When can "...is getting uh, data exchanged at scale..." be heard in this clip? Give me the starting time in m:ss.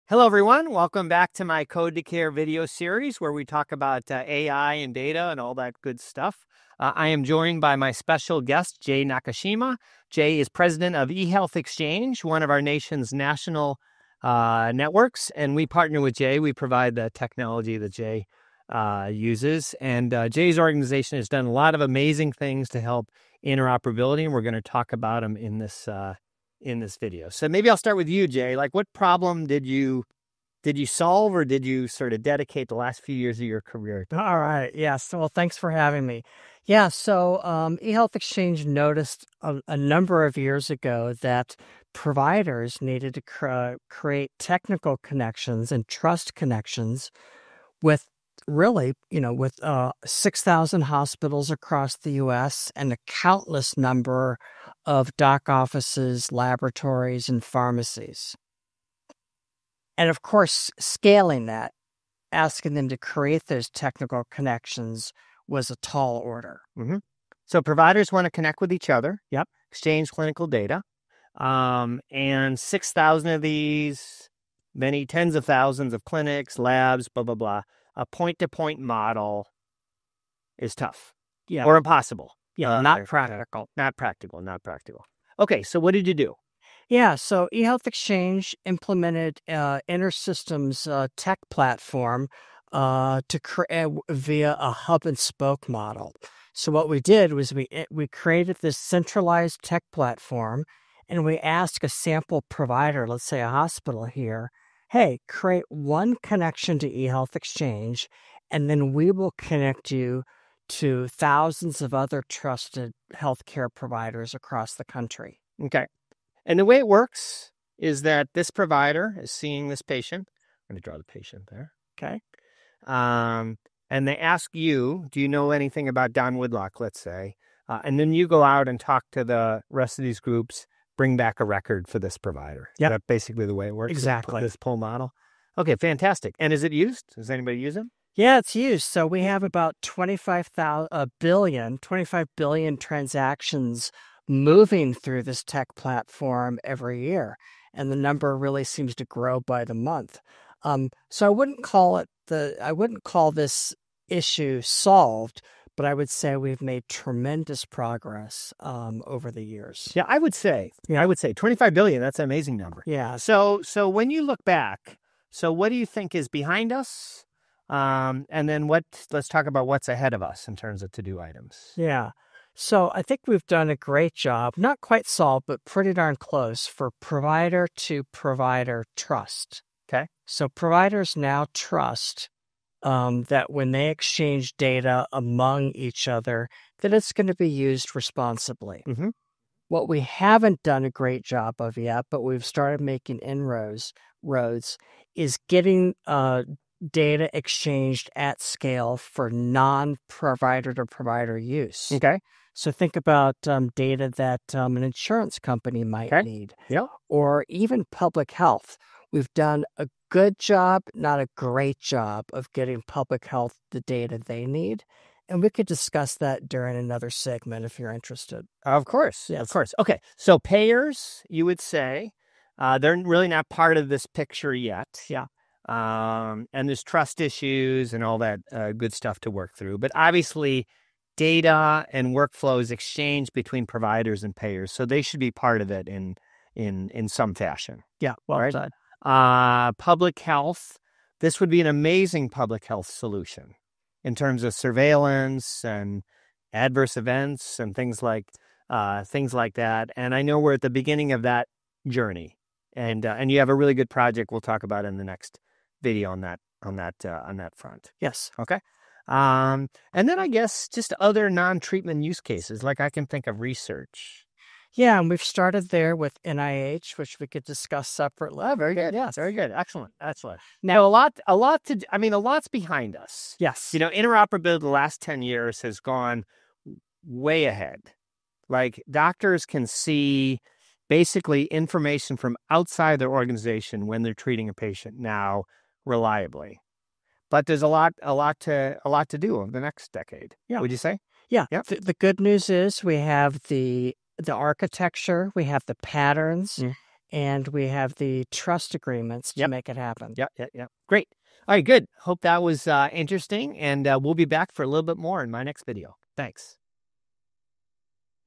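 3:15.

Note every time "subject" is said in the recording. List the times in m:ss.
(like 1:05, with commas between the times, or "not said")
not said.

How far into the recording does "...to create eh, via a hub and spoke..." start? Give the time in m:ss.
1:33.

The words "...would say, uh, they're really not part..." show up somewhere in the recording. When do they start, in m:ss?
3:41.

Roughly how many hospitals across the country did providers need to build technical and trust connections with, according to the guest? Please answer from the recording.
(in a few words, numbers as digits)
6,000.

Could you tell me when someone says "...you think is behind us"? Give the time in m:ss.
2:45.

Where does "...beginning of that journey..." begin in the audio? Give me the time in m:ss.
4:10.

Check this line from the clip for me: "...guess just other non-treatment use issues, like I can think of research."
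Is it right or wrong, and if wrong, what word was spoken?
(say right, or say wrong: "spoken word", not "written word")
wrong: "cases", not "issues".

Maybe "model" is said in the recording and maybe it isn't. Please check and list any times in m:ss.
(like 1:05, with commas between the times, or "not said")
1:18, 1:35, 2:14.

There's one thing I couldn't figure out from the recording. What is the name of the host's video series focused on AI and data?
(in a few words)
Code to Care.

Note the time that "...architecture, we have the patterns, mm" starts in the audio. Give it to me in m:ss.
4:54.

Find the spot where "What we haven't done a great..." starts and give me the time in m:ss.
3:09.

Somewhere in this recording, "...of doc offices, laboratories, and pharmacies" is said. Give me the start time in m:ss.
0:54.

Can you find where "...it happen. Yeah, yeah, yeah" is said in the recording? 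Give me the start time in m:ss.
4:59.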